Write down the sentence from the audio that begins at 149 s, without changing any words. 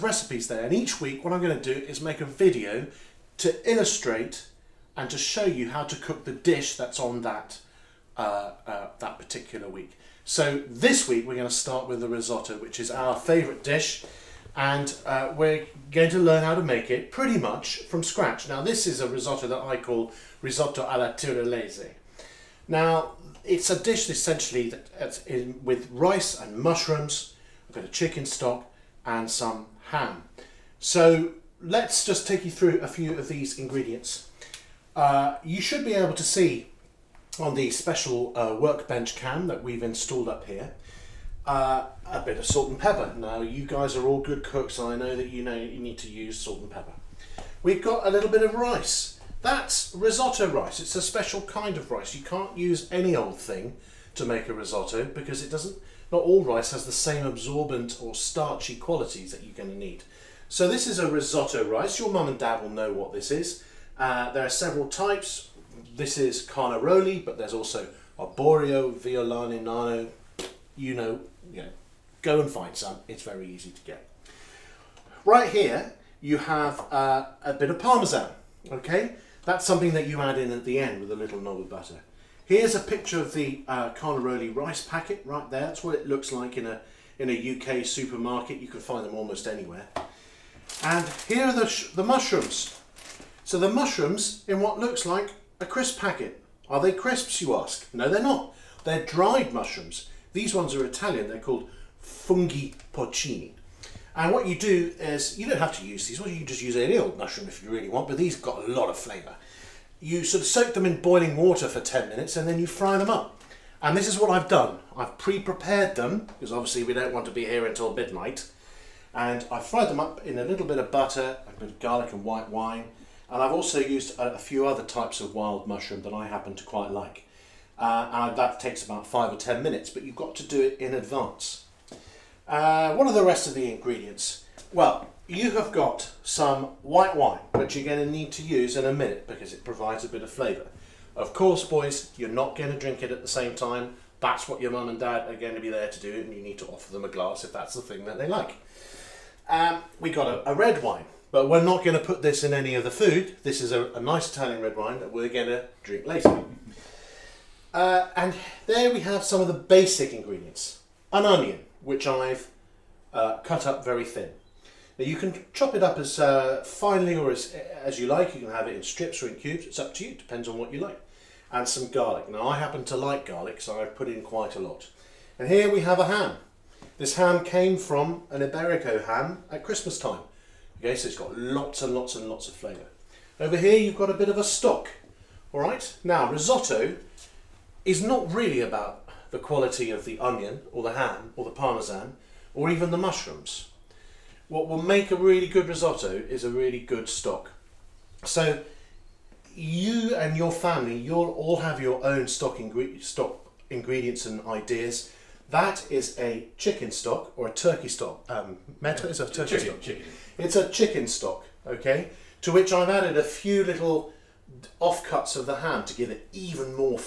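Um, we got a, a, red wine, but we're not going to put this in any of the food.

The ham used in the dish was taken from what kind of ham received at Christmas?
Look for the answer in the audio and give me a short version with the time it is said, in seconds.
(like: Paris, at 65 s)
Iberico ham, at 178 s.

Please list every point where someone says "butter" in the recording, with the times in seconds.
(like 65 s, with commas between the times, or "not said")
81 s, 120 s.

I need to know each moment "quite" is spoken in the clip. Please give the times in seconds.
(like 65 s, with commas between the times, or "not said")
126 s, 174 s.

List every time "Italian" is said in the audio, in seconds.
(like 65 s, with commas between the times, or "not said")
100 s, 154 s.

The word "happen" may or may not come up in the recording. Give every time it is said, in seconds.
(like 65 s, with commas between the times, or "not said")
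126 s, 172 s.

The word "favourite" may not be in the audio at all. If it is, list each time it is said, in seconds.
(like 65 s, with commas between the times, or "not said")
13 s.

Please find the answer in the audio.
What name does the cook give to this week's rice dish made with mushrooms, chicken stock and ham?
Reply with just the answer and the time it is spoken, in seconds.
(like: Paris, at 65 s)
risotto alla tirolese, at 20 s.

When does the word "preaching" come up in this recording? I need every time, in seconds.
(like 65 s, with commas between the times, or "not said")
not said.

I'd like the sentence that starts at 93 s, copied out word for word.
So the mushrooms in what looks like a crisp packet.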